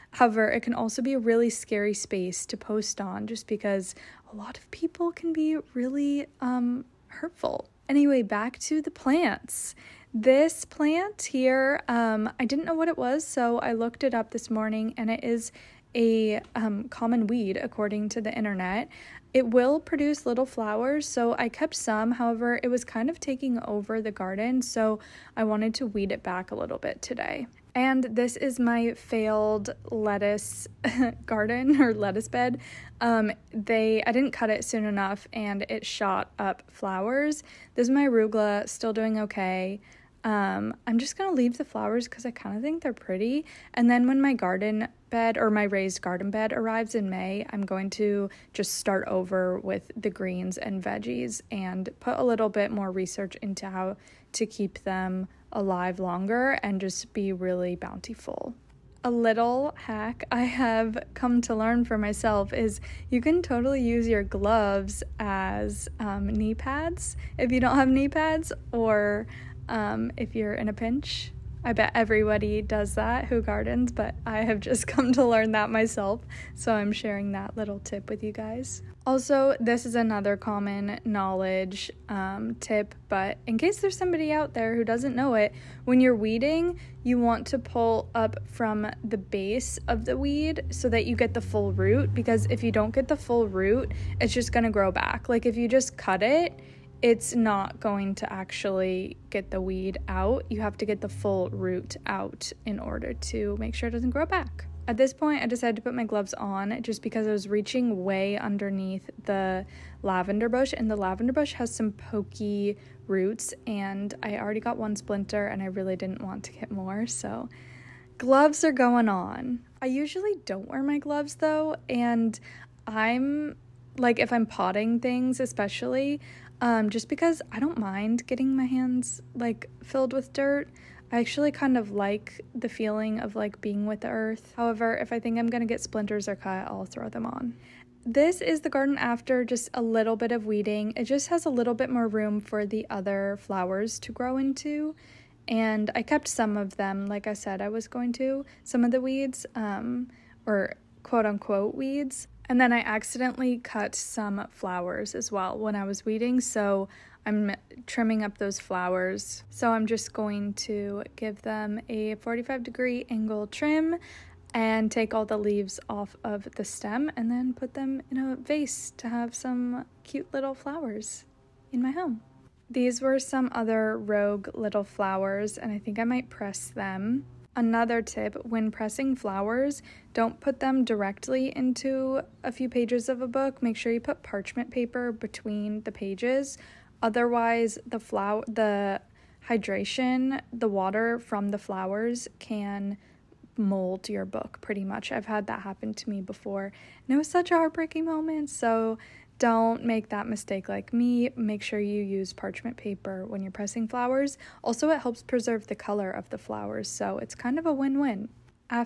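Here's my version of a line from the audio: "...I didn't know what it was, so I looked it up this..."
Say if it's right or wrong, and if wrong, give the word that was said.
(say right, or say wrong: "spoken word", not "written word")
right.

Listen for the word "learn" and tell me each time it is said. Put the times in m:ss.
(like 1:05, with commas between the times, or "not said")
1:01, 1:15.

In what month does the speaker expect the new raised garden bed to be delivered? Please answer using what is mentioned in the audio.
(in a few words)
May.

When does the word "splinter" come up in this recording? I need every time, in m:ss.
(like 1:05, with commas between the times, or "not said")
1:54, 2:15.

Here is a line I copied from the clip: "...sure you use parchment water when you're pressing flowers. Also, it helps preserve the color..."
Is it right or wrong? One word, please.
wrong.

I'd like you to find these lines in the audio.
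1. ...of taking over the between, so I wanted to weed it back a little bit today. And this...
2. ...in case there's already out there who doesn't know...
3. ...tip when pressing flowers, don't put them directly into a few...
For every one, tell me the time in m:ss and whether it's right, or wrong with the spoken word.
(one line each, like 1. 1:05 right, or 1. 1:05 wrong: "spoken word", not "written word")
1. 0:23 wrong: "garden", not "between"
2. 1:23 wrong: "somebody", not "already"
3. 2:58 right.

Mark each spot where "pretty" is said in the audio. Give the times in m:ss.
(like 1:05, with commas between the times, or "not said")
0:42, 3:14.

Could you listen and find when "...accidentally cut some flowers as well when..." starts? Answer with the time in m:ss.
2:32.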